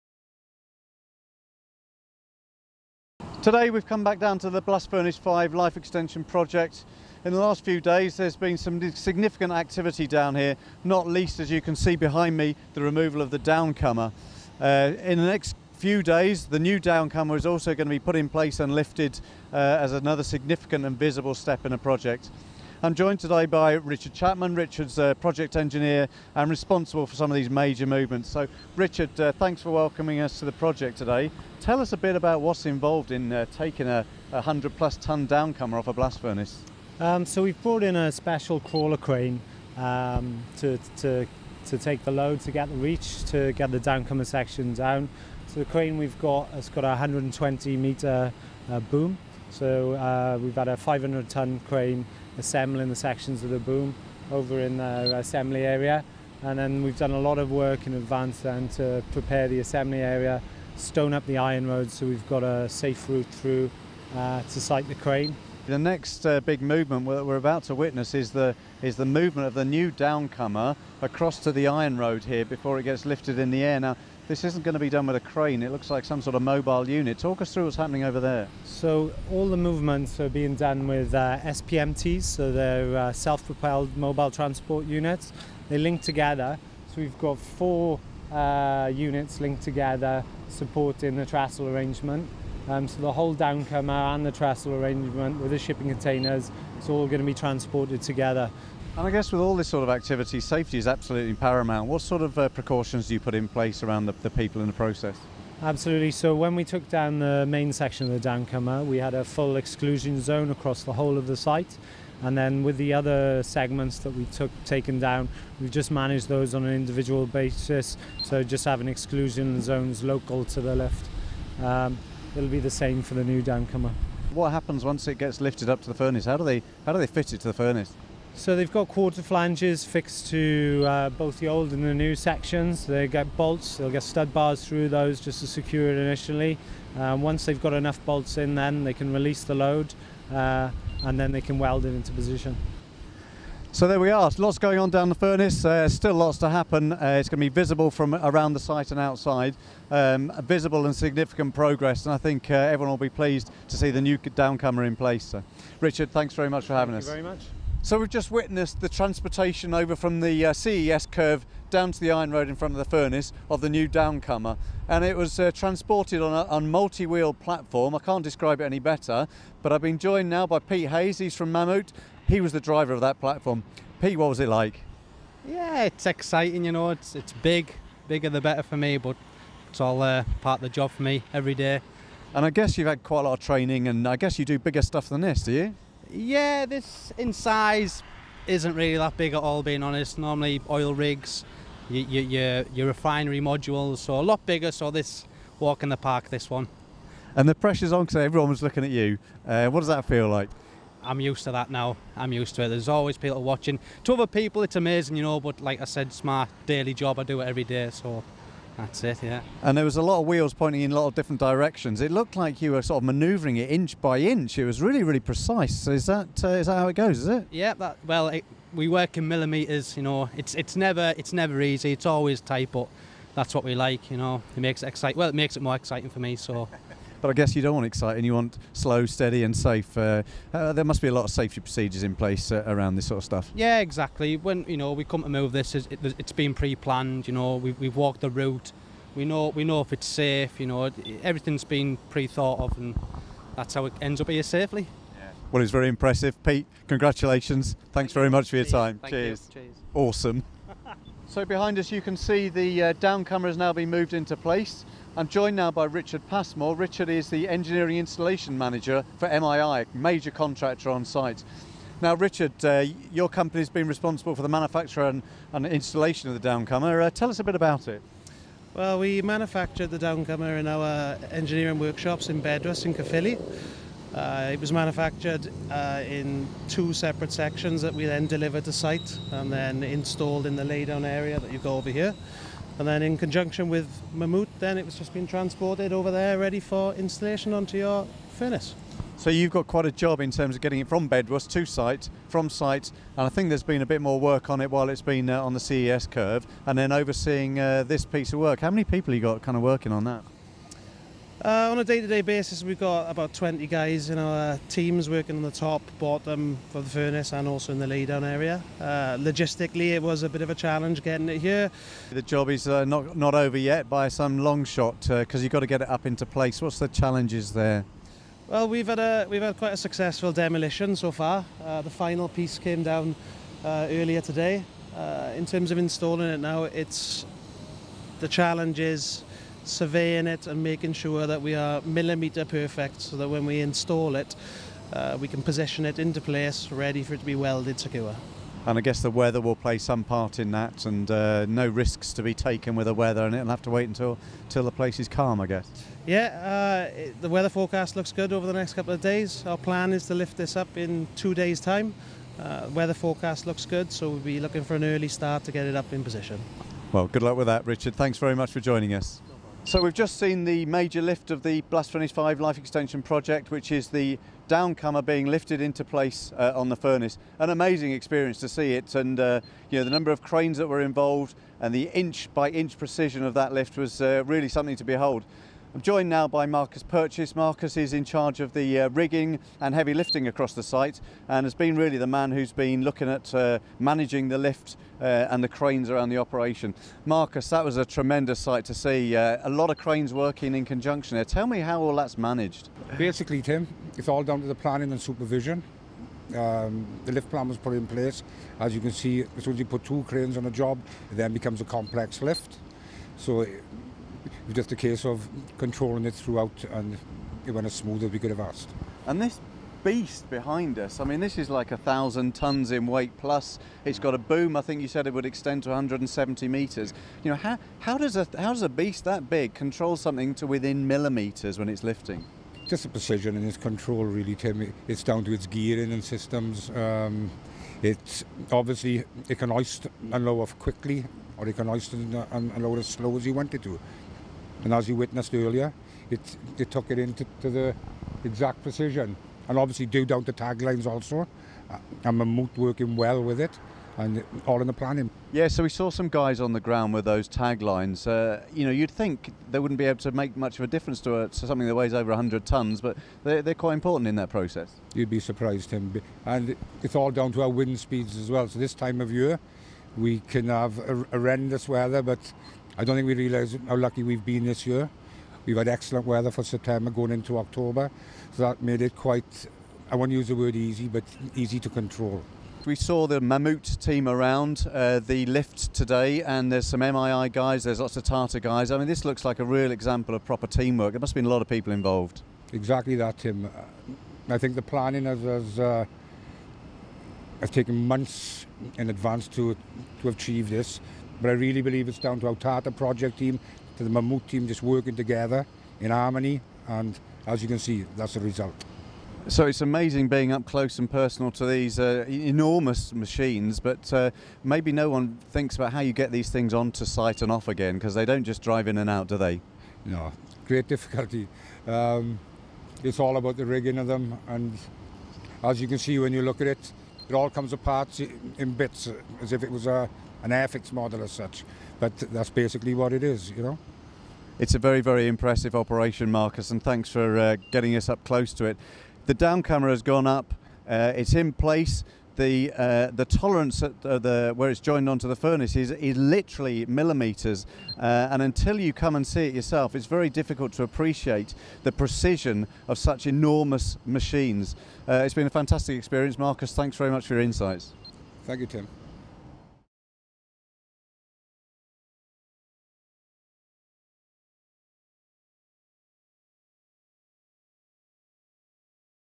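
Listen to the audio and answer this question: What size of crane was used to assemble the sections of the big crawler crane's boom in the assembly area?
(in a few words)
500 ton.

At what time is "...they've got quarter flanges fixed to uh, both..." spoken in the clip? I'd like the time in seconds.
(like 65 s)
128 s.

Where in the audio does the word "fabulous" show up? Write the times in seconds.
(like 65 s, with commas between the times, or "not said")
not said.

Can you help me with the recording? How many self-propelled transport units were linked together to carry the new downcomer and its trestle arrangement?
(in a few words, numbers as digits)
4.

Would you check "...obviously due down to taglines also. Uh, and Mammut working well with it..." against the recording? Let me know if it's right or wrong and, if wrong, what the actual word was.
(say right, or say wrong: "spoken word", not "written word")
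right.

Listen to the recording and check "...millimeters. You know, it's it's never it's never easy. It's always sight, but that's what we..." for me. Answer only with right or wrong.
wrong.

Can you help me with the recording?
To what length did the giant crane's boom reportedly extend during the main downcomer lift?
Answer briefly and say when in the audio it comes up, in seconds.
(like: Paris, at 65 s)
170 meters, at 415 s.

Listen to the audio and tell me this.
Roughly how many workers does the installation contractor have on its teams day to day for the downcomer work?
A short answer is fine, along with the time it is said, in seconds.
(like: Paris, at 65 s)
20, at 303 s.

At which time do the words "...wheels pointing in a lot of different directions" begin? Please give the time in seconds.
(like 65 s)
210 s.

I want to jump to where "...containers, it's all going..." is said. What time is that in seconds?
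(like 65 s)
95 s.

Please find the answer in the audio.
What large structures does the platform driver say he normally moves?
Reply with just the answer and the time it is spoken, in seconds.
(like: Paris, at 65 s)
Oil rigs, at 190 s.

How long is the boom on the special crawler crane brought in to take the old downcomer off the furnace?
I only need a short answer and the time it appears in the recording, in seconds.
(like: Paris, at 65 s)
120 meters, at 46 s.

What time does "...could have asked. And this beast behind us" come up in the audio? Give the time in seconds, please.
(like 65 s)
408 s.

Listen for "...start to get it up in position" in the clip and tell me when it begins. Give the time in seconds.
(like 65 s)
355 s.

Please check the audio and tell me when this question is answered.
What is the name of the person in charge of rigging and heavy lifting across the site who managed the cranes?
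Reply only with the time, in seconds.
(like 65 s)
376 s.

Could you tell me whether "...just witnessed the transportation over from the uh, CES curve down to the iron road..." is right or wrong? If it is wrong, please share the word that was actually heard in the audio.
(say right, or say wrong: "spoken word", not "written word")
right.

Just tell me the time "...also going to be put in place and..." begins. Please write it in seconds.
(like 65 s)
17 s.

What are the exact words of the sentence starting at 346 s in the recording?
Yeah, uh, it, the weather forecast looks good over the next couple of days.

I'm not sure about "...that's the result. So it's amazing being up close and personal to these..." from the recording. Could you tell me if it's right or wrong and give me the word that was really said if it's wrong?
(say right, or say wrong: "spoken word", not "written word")
right.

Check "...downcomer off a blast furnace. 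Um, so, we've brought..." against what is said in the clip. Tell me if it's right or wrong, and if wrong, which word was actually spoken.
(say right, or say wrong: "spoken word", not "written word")
right.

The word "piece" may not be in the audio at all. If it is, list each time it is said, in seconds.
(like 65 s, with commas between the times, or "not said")
298 s, 322 s.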